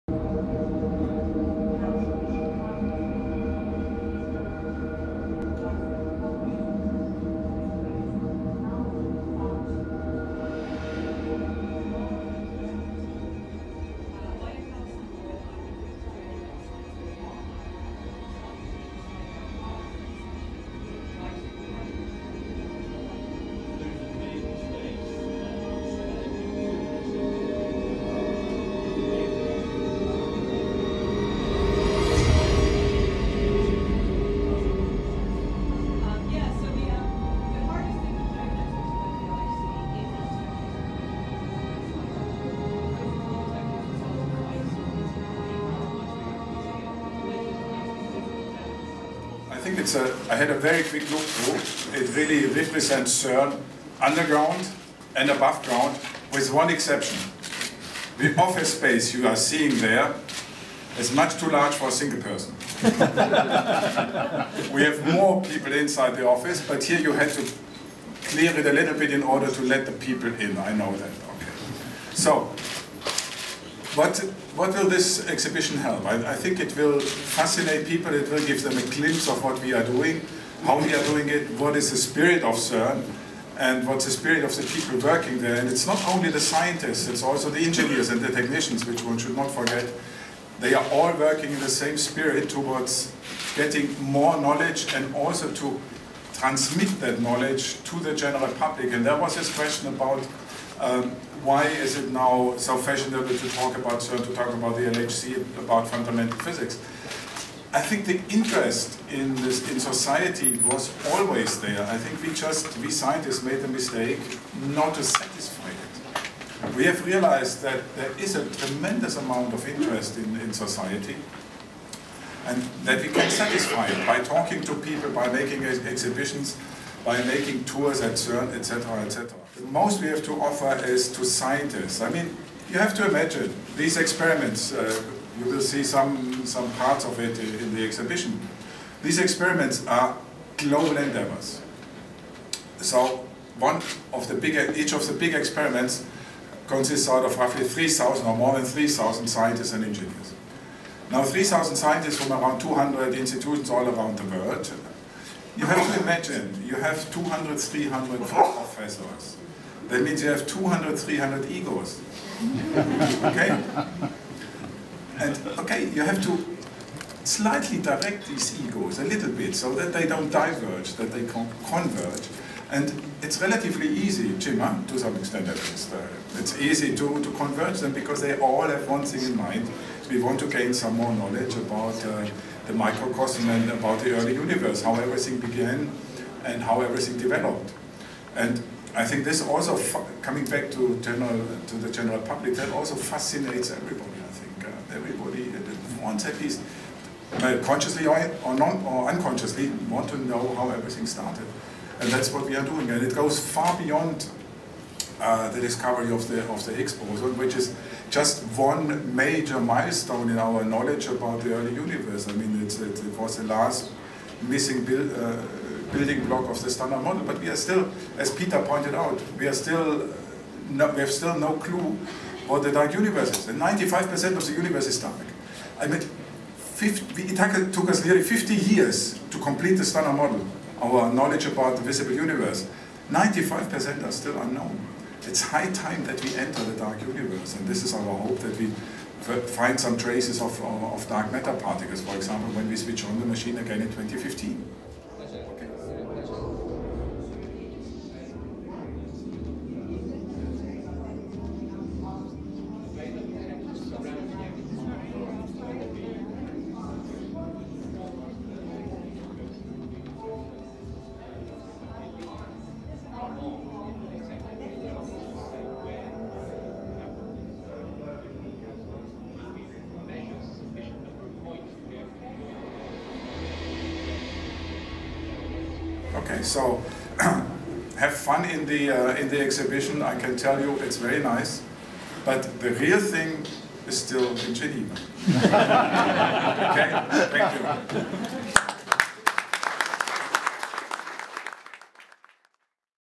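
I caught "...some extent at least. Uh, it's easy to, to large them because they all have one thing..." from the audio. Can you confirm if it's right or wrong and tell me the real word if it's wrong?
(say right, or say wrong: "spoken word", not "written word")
wrong: "converge", not "large".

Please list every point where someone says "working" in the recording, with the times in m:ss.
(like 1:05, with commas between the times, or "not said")
1:25, 1:31.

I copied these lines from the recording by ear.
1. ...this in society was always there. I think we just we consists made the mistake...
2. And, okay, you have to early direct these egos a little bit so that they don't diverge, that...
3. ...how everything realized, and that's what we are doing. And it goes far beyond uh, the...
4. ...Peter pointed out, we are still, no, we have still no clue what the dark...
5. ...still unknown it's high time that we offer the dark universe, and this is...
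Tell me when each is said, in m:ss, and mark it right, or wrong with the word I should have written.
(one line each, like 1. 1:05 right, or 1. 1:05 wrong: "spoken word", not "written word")
1. 1:49 wrong: "scientists", not "consists"
2. 2:45 wrong: "slightly", not "early"
3. 3:20 wrong: "started", not "realized"
4. 3:38 right
5. 3:54 wrong: "enter", not "offer".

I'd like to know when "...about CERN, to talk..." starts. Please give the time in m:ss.
1:43.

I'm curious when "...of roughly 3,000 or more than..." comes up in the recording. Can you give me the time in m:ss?
2:27.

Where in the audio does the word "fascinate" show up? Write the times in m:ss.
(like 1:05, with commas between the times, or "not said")
1:17, 3:12.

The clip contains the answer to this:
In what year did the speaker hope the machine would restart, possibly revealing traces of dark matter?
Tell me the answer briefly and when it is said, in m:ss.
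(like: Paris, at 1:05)
2015, at 4:03.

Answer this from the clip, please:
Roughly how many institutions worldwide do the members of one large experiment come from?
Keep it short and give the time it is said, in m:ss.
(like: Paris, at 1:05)
200, at 2:32.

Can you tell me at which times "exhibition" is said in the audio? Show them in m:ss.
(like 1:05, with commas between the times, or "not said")
1:15, 2:05, 2:17, 4:39.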